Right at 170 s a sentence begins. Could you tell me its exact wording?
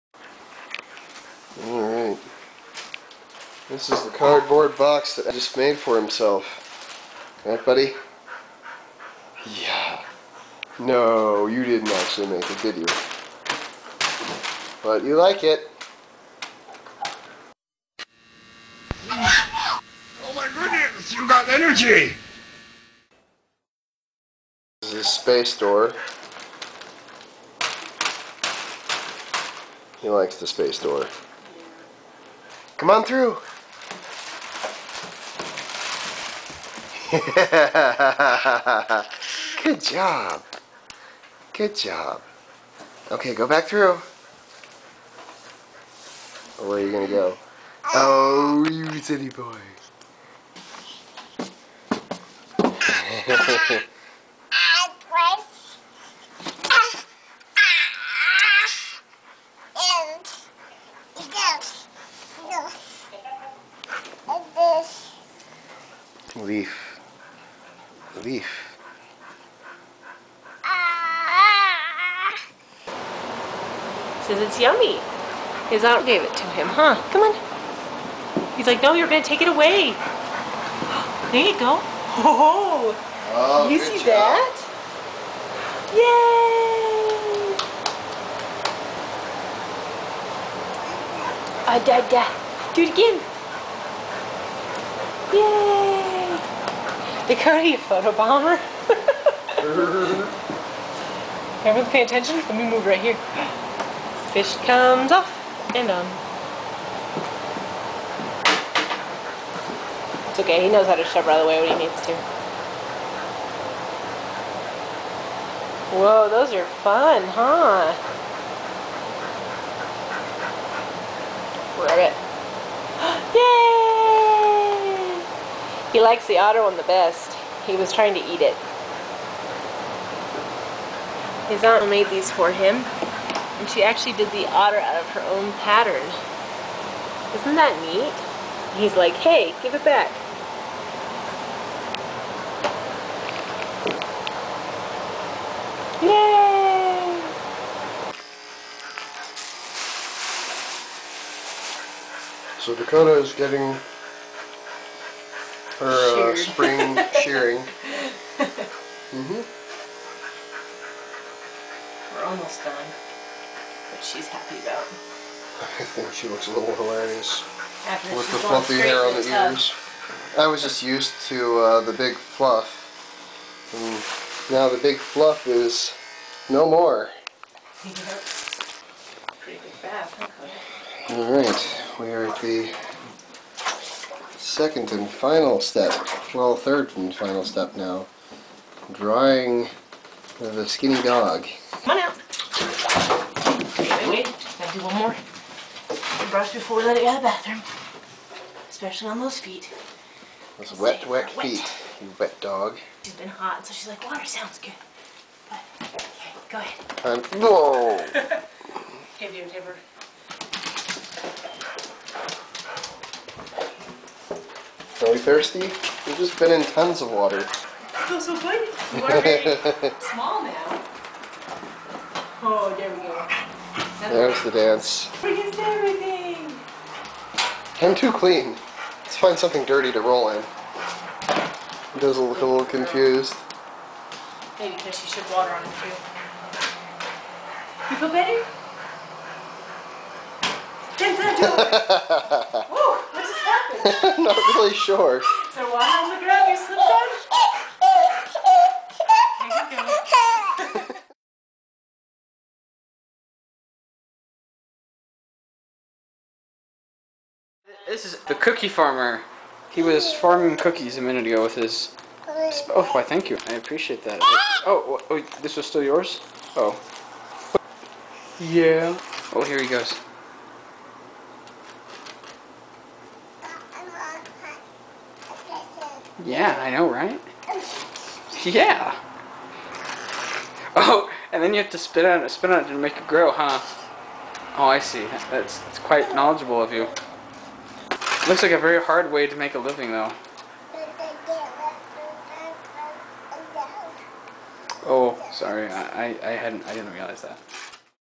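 I was just used to uh, the big fluff, and now the big fluff is no more.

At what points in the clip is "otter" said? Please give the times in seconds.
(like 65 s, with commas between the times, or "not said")
126 s, 134 s.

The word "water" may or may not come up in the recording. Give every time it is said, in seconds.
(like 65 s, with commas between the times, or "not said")
204 s, 217 s, 235 s.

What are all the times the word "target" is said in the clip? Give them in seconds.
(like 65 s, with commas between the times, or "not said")
not said.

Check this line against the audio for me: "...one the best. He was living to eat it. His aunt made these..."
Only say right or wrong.
wrong.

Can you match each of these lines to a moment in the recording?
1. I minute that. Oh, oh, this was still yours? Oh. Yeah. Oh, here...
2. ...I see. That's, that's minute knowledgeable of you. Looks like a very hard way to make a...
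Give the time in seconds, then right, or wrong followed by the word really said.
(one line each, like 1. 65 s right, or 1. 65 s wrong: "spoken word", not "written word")
1. 263 s wrong: "appreciate", not "minute"
2. 284 s wrong: "quite", not "minute".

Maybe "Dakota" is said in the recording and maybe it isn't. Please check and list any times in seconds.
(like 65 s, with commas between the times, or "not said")
97 s, 152 s.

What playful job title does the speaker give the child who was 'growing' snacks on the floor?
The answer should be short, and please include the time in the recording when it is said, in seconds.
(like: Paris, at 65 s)
cookie farmer, at 258 s.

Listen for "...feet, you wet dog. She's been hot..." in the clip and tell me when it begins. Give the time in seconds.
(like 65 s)
201 s.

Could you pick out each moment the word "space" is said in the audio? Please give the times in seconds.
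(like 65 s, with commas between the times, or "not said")
25 s, 30 s.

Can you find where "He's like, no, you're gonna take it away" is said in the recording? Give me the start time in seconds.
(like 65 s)
78 s.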